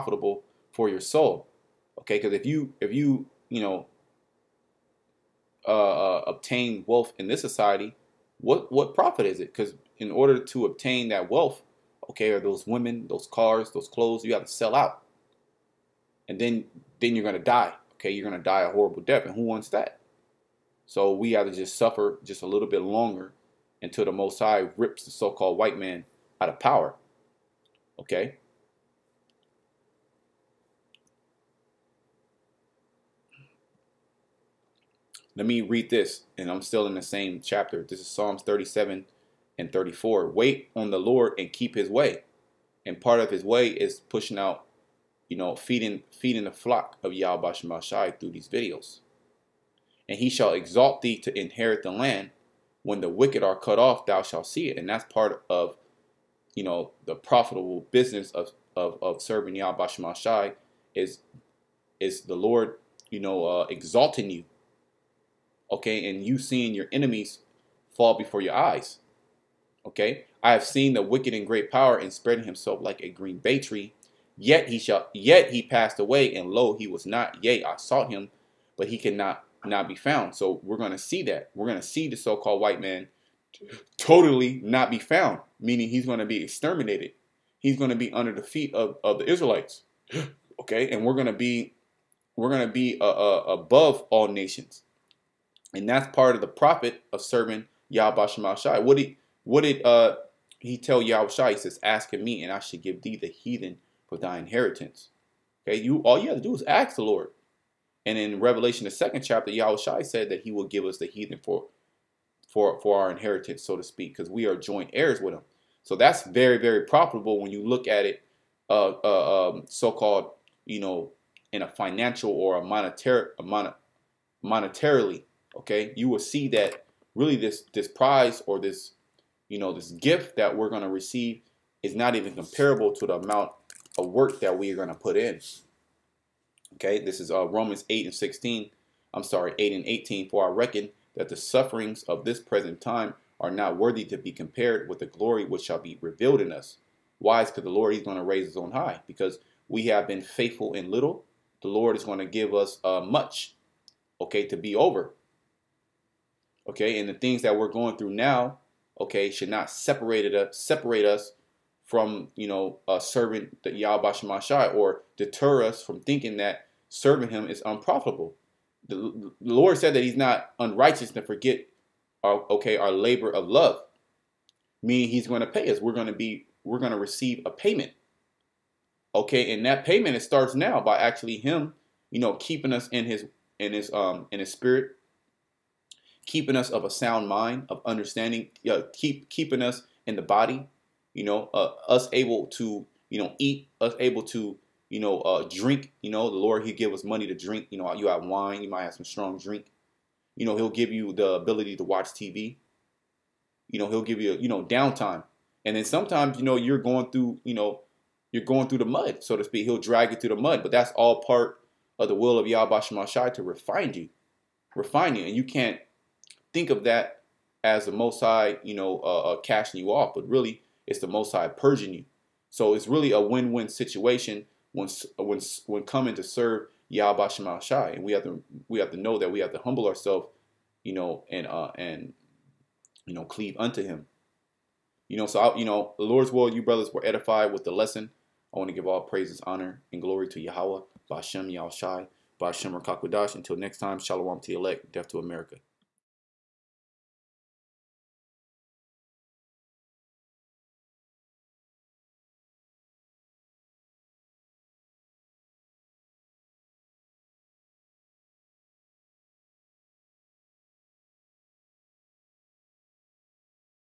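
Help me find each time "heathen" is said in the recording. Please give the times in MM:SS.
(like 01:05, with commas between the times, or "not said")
01:43, 01:51.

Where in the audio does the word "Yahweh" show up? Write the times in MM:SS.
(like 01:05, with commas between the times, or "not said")
00:47, 00:59, 02:43, 03:32, 03:46, 04:00.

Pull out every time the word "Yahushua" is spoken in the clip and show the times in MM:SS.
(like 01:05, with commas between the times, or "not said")
01:41, 01:49.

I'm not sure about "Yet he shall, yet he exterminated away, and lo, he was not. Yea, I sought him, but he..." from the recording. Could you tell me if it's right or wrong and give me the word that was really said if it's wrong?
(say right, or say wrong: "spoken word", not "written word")
wrong: "passed", not "exterminated".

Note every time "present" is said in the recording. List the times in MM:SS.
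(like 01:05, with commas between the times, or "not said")
02:22.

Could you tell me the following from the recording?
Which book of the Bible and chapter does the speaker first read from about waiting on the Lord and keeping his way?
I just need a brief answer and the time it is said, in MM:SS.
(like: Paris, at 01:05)
Psalms 37, at 00:38.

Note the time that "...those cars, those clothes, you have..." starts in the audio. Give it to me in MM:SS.
00:13.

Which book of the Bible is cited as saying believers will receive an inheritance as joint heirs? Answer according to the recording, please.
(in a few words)
Revelation.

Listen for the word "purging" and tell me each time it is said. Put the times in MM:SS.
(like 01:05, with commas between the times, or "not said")
03:41.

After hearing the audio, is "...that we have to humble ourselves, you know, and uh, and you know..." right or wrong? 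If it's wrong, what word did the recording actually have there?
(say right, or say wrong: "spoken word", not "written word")
right.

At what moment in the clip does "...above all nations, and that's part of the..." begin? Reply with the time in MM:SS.
01:33.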